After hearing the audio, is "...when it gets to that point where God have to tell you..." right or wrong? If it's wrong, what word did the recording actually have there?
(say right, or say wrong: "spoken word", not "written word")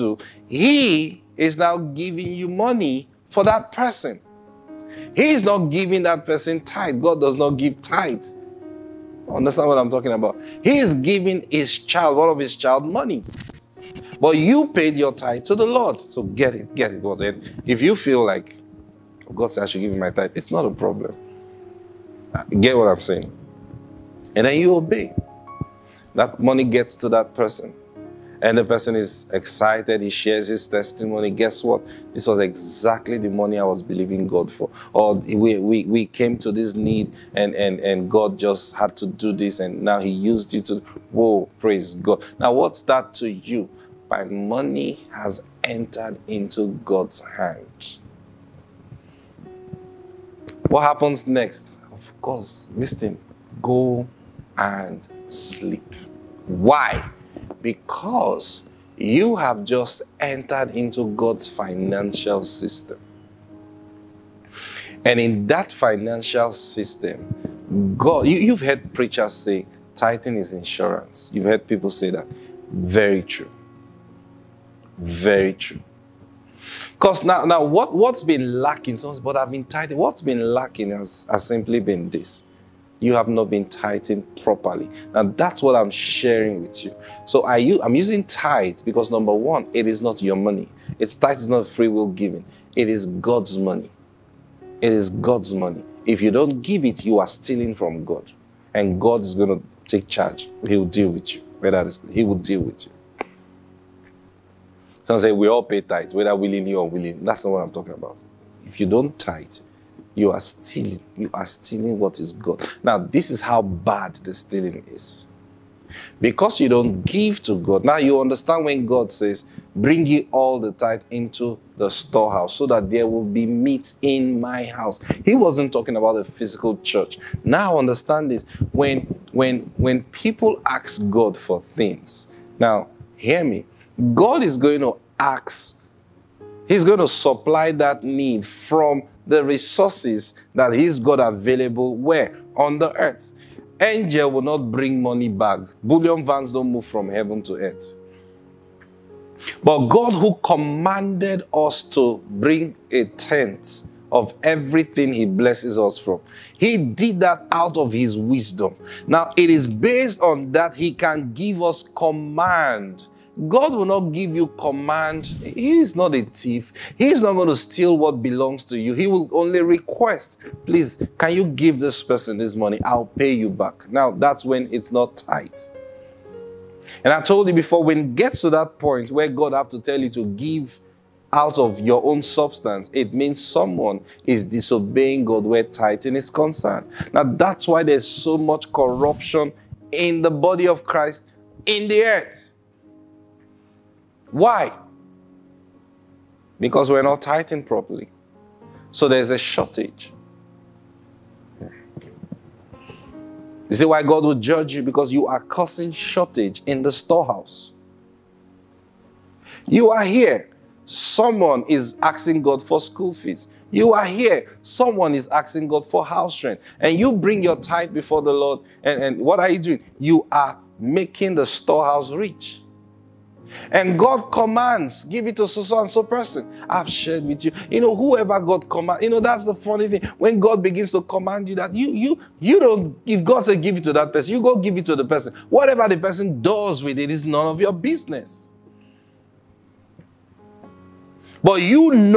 right.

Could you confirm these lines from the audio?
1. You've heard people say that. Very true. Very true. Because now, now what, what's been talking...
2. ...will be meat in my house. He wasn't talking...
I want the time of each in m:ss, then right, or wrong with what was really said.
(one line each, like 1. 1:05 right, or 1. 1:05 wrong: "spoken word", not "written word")
1. 1:11 wrong: "lacking", not "talking"
2. 2:03 right.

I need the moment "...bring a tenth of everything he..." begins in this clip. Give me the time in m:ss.
2:32.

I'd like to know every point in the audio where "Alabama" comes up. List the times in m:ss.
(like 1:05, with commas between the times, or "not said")
not said.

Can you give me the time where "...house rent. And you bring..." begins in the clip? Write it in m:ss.
3:36.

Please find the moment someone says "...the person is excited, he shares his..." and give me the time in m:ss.
0:28.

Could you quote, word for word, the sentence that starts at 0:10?
He is giving his child, one of his child, money.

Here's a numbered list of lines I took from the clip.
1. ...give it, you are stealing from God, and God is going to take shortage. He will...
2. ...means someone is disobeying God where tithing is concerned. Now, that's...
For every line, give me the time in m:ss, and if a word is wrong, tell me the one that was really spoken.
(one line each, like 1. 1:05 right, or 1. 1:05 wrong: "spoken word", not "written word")
1. 1:36 wrong: "charge", not "shortage"
2. 3:03 right.